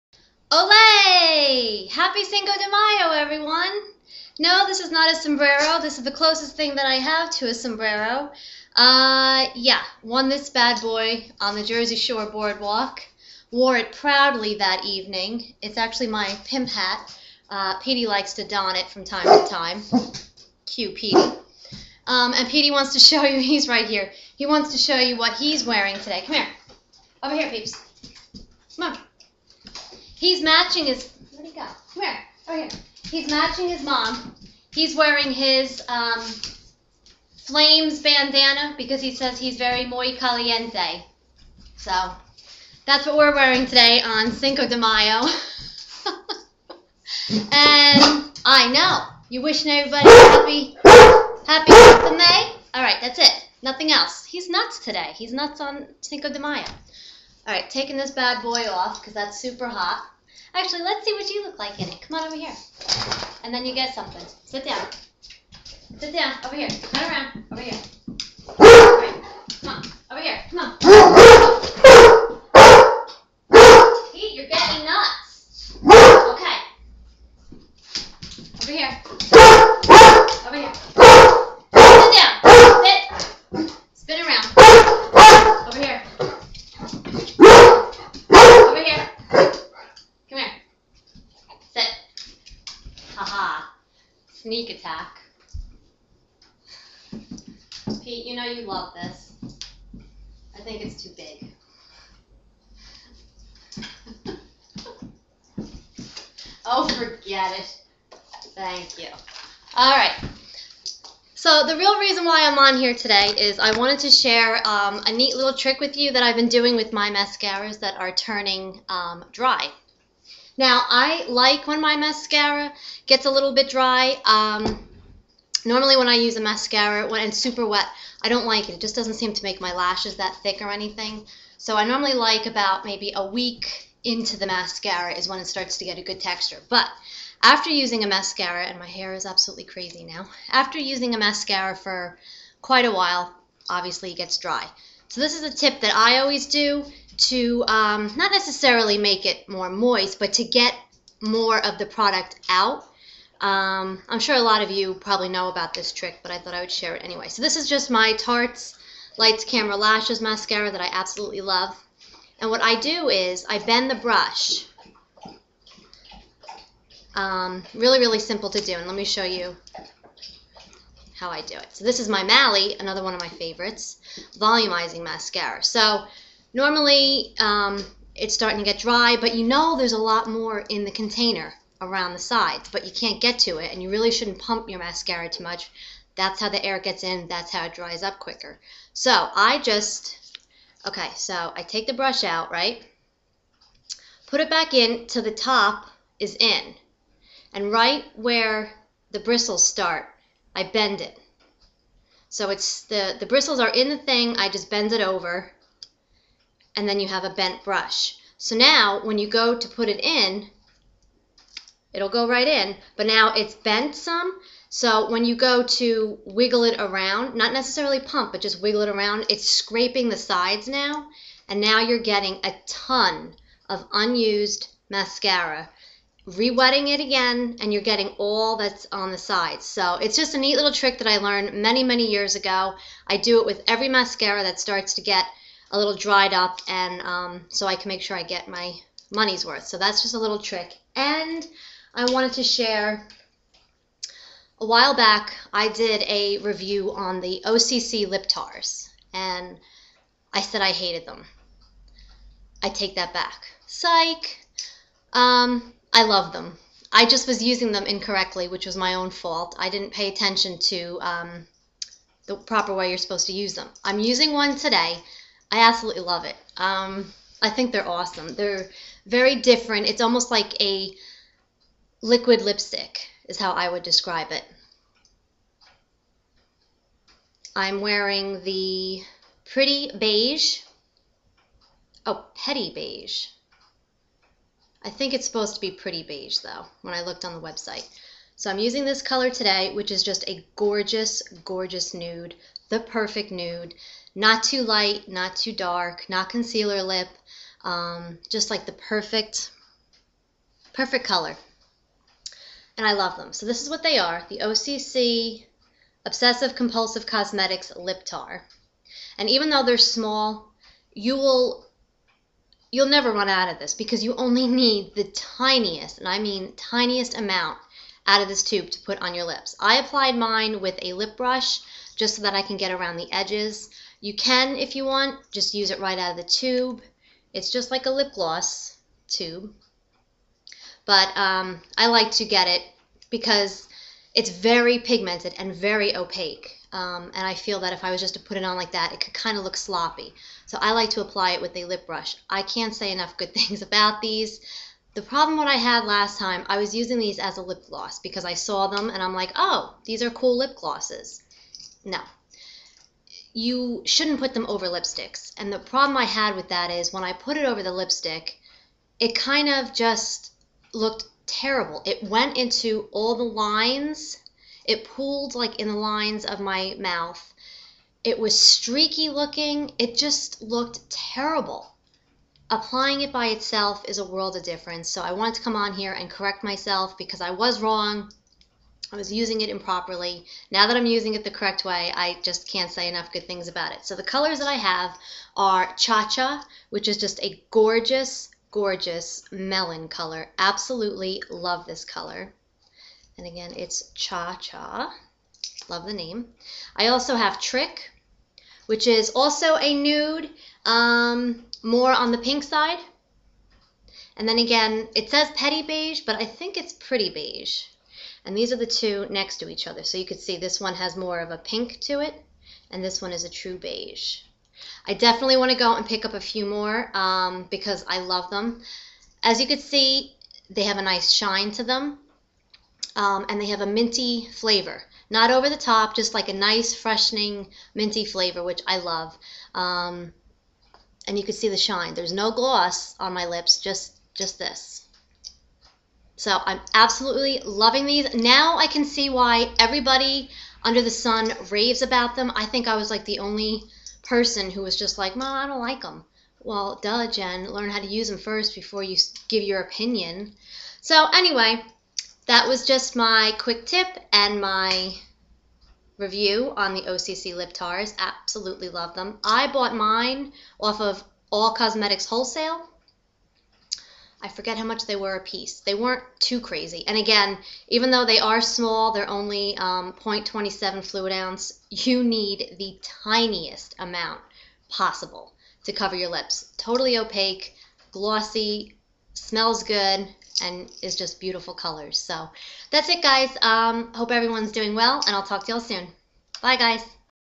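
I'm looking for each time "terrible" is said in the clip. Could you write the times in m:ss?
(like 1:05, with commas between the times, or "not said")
6:01, 6:10.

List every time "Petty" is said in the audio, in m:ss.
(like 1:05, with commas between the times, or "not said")
4:42, 6:45.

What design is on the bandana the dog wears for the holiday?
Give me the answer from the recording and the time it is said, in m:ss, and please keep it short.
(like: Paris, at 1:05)
Flames, at 0:37.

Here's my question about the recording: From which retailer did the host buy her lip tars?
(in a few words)
All Cosmetics Wholesale.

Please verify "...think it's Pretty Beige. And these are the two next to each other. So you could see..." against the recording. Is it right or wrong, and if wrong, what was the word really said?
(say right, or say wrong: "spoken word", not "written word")
right.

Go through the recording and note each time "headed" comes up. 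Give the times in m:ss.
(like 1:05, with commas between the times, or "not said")
not said.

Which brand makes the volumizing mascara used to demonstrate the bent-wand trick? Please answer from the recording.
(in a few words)
Mally.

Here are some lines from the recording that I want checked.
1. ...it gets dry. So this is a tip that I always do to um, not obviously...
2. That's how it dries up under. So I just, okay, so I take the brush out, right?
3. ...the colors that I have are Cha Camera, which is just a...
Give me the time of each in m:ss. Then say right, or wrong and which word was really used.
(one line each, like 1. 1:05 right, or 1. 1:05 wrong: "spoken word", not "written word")
1. 2:24 wrong: "necessarily", not "obviously"
2. 3:07 wrong: "quicker", not "under"
3. 6:23 wrong: "Cha", not "Camera".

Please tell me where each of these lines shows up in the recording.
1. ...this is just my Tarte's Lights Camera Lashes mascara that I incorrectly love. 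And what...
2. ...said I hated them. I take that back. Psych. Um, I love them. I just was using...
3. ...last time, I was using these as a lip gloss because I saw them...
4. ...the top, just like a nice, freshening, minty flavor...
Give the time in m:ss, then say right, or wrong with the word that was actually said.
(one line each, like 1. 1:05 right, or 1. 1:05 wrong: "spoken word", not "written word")
1. 2:37 wrong: "absolutely", not "incorrectly"
2. 4:10 right
3. 5:45 right
4. 7:05 right.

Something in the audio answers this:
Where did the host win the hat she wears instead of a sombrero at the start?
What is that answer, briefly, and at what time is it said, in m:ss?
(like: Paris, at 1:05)
Jersey Shore boardwalk, at 0:11.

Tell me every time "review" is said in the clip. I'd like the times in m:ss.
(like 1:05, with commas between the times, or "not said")
4:06, 7:35.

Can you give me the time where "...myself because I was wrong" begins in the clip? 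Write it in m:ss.
6:16.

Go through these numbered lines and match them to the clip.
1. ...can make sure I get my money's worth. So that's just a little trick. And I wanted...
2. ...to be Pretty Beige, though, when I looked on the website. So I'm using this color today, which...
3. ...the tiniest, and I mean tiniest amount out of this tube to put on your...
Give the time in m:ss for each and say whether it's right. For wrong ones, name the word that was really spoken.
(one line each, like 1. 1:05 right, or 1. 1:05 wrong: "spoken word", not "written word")
1. 3:57 right
2. 4:45 right
3. 5:14 right.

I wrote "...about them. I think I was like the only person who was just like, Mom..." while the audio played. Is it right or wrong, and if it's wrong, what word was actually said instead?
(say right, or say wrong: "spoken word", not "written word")
right.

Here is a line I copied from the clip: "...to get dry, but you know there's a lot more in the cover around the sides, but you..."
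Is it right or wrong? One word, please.
wrong.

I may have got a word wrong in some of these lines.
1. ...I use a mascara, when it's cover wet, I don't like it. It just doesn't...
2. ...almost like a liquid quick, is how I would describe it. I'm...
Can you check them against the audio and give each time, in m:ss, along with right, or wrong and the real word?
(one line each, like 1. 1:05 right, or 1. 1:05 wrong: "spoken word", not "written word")
1. 2:06 wrong: "super", not "cover"
2. 4:30 wrong: "lipstick", not "quick".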